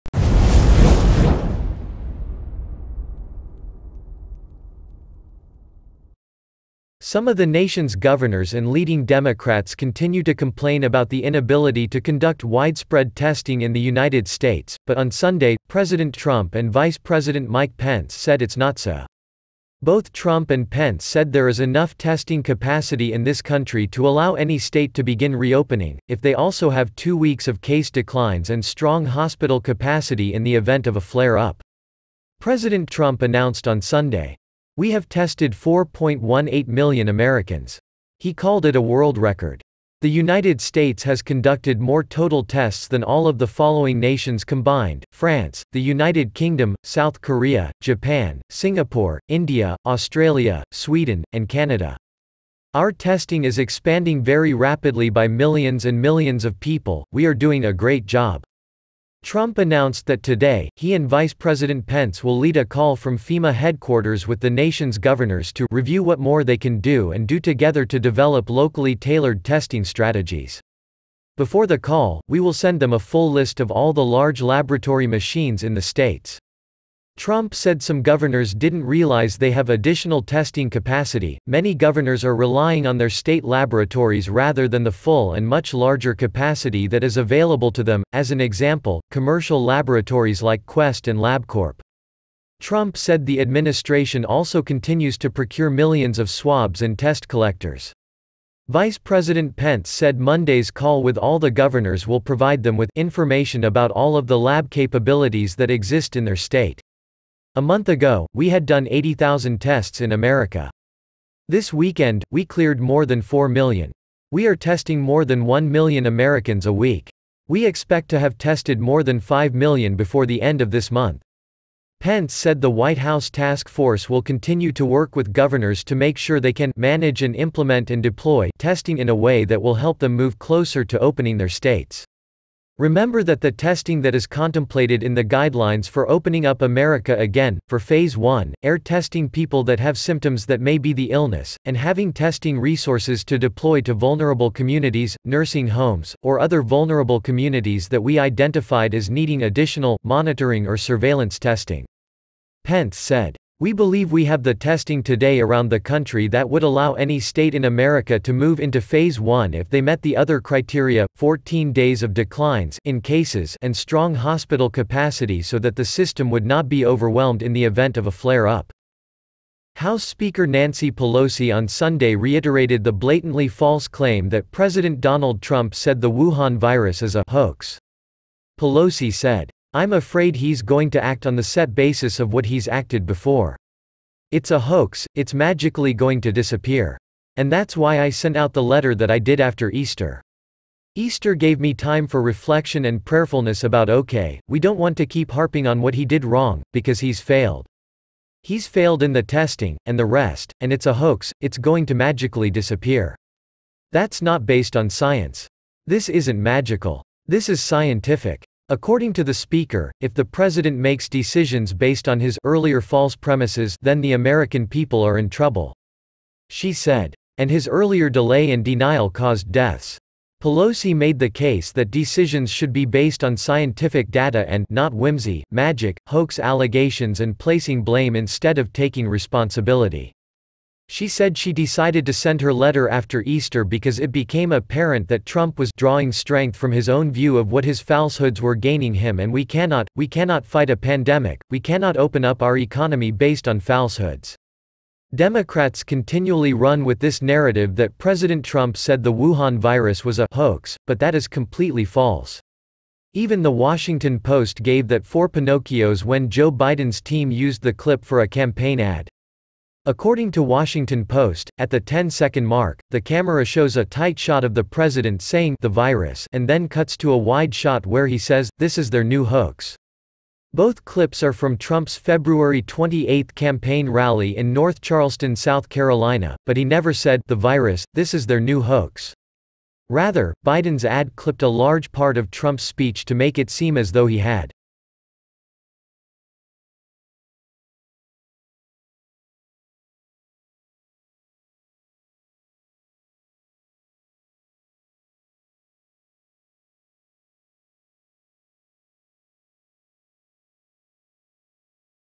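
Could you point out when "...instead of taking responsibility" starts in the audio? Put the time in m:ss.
3:48.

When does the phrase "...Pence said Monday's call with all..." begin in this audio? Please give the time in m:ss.
1:39.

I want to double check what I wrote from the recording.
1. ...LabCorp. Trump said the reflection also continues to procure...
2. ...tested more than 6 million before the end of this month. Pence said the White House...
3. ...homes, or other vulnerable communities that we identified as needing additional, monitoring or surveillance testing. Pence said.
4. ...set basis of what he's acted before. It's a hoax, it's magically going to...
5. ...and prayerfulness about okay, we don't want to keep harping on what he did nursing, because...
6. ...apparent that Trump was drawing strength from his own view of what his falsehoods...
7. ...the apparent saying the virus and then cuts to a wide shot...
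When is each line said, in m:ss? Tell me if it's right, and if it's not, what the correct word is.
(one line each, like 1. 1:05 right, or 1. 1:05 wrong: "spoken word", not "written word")
1. 1:31 wrong: "administration", not "reflection"
2. 1:58 wrong: "5", not "6"
3. 2:25 right
4. 3:01 right
5. 3:12 wrong: "wrong", not "nursing"
6. 3:54 right
7. 4:24 wrong: "president", not "apparent".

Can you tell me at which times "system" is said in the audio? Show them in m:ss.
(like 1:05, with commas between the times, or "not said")
2:45.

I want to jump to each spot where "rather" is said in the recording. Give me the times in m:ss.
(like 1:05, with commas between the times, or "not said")
1:24, 4:39.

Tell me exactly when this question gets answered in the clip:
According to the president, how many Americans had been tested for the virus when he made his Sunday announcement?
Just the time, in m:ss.
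0:35.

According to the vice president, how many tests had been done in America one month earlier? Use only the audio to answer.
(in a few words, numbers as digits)
80,000.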